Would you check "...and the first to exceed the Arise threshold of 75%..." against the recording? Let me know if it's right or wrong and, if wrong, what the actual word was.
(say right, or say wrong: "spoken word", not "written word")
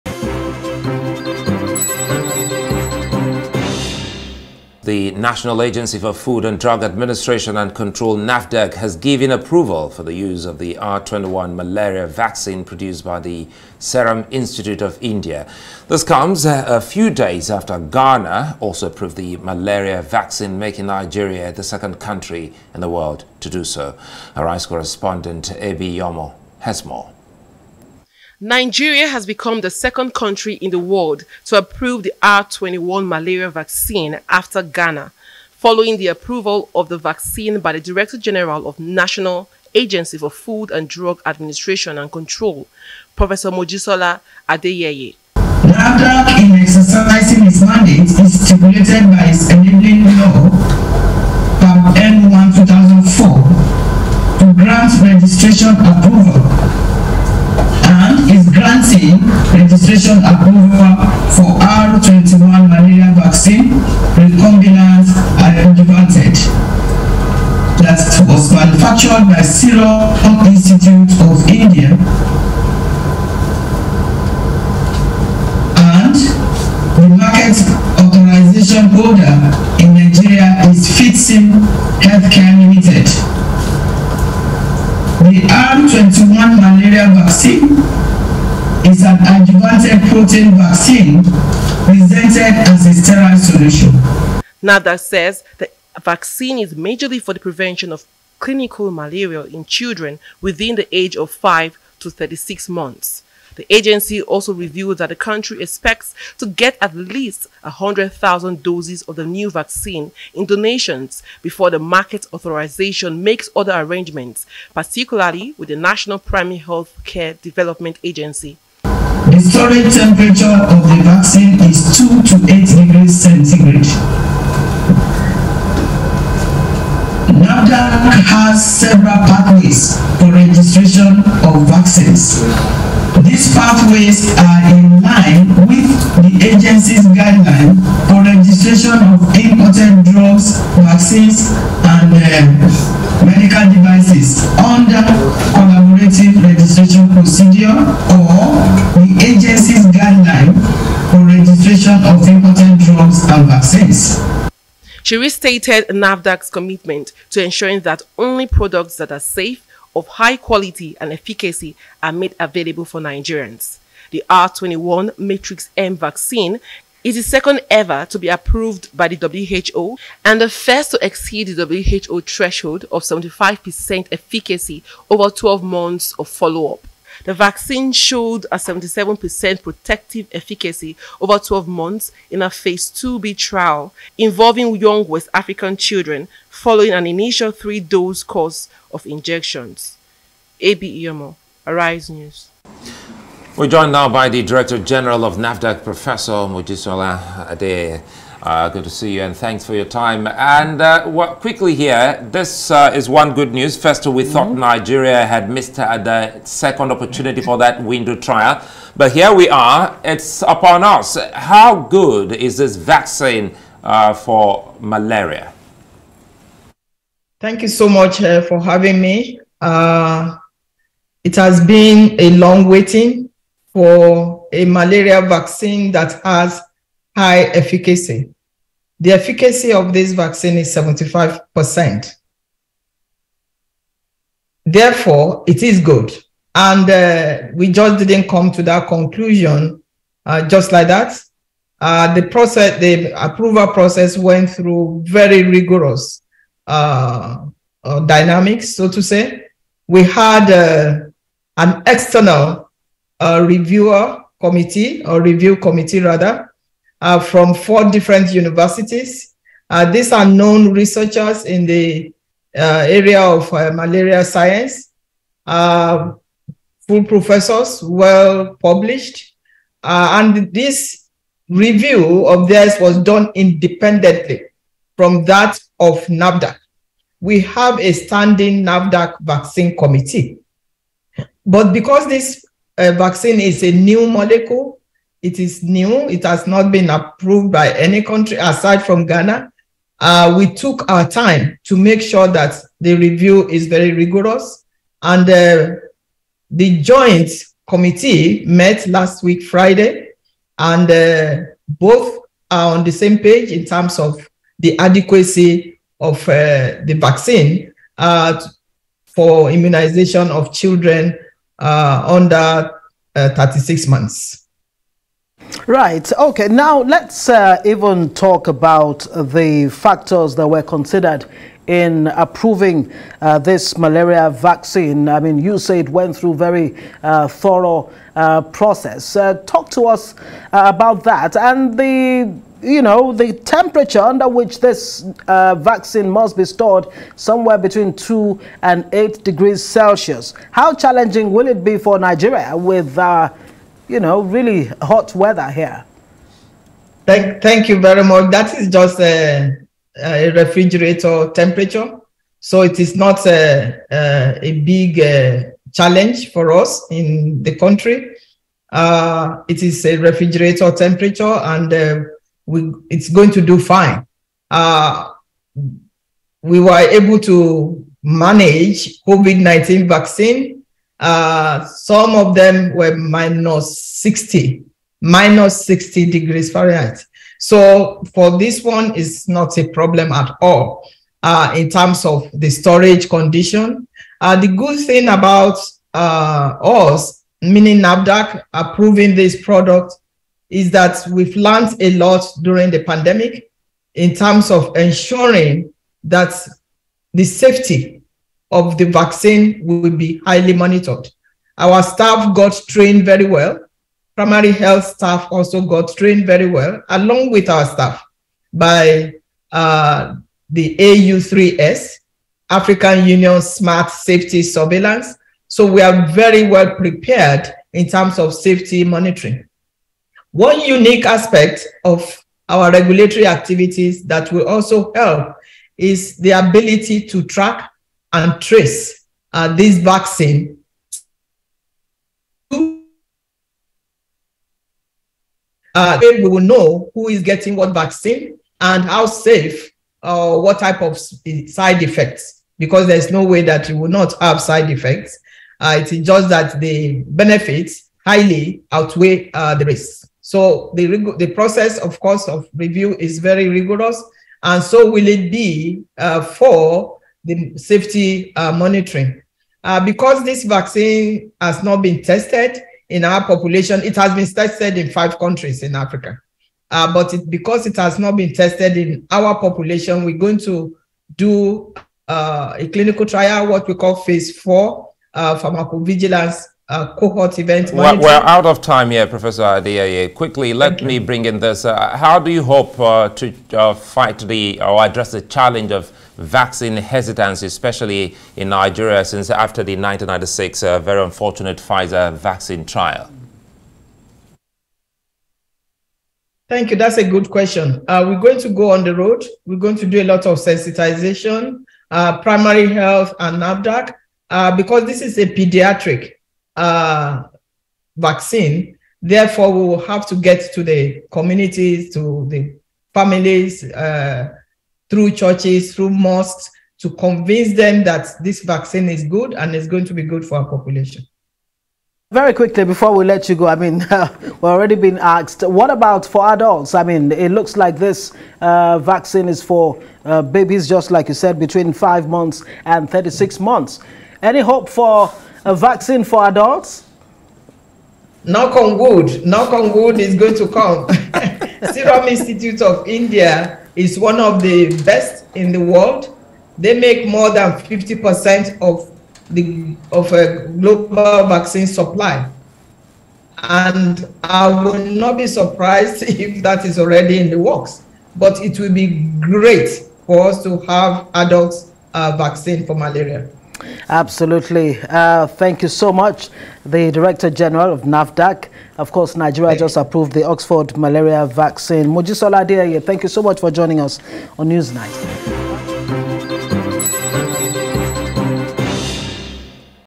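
wrong: "WHO", not "Arise".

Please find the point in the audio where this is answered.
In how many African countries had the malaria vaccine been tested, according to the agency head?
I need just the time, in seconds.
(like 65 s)
464 s.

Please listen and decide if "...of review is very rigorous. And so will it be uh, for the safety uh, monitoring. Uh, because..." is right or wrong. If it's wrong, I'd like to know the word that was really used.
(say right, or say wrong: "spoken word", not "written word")
right.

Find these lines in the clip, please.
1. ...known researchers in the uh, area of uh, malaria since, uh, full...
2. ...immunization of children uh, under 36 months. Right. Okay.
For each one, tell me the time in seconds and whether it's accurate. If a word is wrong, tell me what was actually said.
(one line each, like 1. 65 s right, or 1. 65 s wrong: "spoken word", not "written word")
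1. 260 s wrong: "science", not "since"
2. 309 s right.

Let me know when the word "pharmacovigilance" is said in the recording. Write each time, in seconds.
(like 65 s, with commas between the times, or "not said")
475 s.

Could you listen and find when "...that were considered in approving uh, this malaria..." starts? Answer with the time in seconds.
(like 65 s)
320 s.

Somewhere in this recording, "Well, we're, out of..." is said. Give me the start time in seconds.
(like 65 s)
477 s.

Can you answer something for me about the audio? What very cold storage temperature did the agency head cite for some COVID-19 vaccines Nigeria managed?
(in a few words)
minus 60 degrees Fahrenheit.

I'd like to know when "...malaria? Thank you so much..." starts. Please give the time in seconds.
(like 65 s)
214 s.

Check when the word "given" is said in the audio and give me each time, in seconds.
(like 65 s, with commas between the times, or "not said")
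8 s.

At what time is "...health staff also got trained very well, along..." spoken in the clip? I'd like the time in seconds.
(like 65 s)
404 s.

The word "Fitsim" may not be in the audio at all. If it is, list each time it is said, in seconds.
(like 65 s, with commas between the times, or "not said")
80 s.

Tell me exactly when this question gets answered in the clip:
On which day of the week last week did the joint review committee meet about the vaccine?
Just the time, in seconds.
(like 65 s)
299 s.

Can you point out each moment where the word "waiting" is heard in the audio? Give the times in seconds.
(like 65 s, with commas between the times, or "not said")
222 s.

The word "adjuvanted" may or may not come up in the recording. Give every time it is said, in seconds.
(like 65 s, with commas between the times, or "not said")
65 s, 89 s.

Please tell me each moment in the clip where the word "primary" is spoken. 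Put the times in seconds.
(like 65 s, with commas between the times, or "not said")
116 s, 404 s, 502 s.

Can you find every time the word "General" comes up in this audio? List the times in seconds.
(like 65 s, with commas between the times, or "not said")
38 s, 194 s, 567 s.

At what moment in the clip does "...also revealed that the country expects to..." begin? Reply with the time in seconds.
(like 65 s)
104 s.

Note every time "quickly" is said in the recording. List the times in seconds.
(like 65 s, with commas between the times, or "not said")
201 s, 480 s, 522 s.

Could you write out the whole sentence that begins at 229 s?
The efficacy of this vaccine is 75%.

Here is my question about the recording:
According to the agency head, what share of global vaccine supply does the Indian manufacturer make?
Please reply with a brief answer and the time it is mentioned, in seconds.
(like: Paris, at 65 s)
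more than 50%, at 547 s.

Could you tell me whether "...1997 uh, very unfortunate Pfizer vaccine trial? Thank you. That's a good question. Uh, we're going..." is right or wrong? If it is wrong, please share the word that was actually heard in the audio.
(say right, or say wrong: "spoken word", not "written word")
wrong: "1996", not "1997".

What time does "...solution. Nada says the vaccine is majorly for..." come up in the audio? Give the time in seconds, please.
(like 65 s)
93 s.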